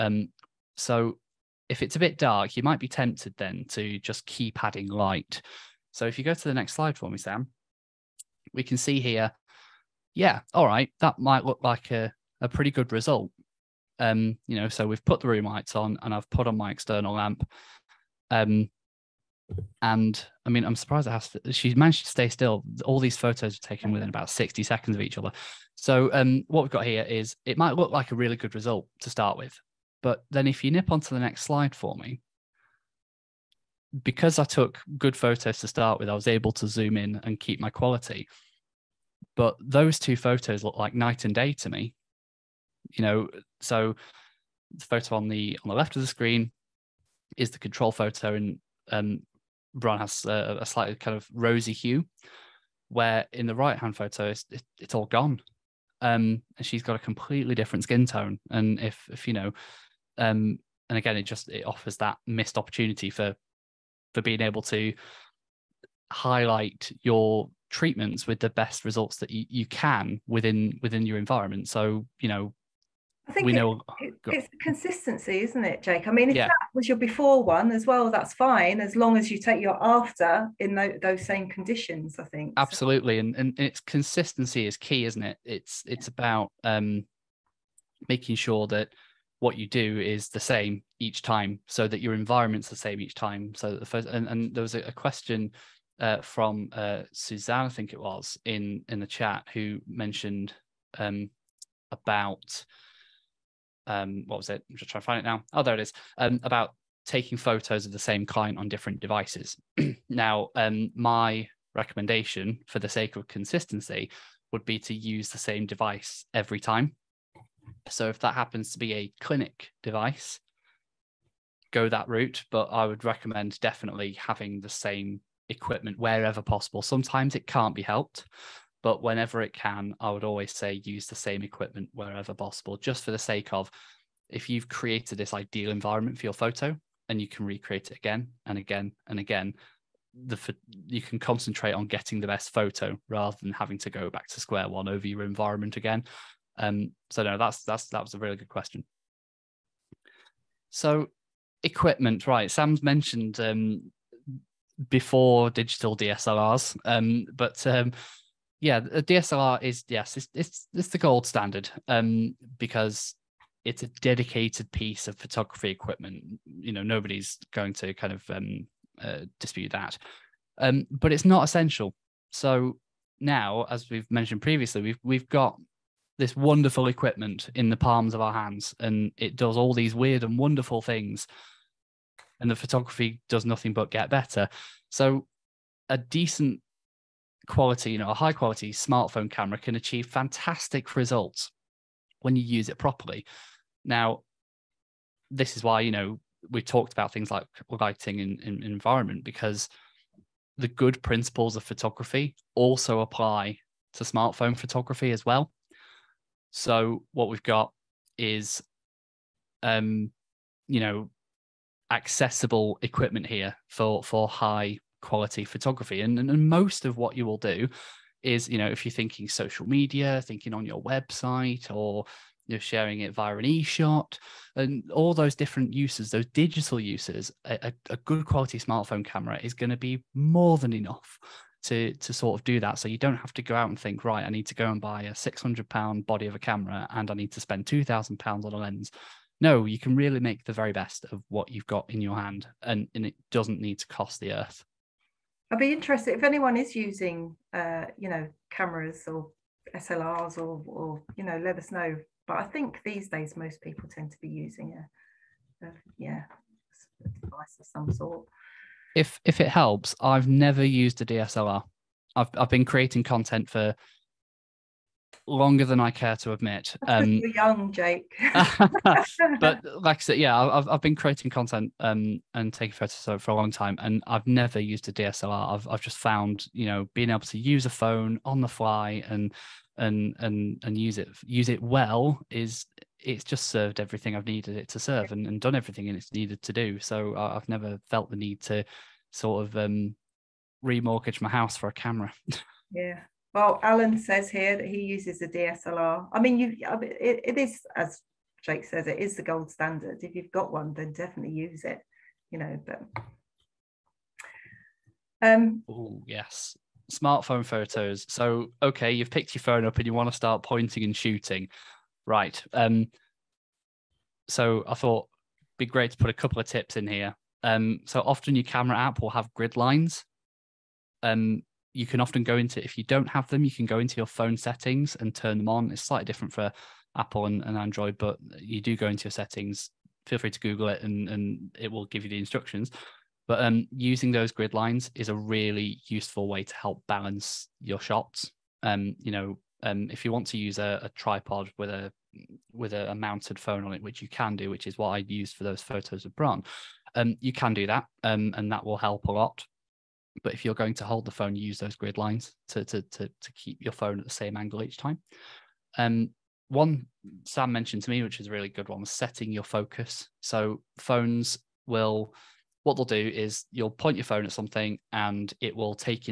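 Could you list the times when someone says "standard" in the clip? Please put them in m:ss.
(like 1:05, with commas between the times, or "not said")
2:41, 4:59.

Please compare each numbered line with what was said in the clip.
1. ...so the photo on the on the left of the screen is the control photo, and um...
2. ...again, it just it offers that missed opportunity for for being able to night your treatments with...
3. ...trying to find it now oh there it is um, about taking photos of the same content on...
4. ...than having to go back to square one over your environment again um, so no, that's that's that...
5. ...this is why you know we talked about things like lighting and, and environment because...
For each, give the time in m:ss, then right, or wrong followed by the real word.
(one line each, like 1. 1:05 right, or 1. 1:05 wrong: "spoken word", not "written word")
1. 0:43 right
2. 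1:00 wrong: "highlight", not "night"
3. 1:44 wrong: "client", not "content"
4. 2:23 right
5. 3:15 right.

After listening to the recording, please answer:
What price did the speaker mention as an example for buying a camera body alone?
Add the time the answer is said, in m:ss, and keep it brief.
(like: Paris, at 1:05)
£600, at 3:55.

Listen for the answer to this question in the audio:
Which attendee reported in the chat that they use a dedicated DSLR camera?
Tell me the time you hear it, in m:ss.
4:53.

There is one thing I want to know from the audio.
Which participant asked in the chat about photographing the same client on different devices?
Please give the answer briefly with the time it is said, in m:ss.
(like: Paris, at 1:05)
Suzanne, at 1:37.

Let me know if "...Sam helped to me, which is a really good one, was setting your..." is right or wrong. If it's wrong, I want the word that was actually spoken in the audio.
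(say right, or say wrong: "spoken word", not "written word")
wrong: "mentioned", not "helped".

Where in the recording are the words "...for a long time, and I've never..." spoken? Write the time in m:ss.
4:33.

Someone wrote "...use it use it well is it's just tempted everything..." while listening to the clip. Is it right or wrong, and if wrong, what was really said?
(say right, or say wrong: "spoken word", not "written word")
wrong: "served", not "tempted".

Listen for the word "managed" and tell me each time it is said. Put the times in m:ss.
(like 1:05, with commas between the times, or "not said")
0:21.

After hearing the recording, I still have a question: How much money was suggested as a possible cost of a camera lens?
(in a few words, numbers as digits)
£2,000.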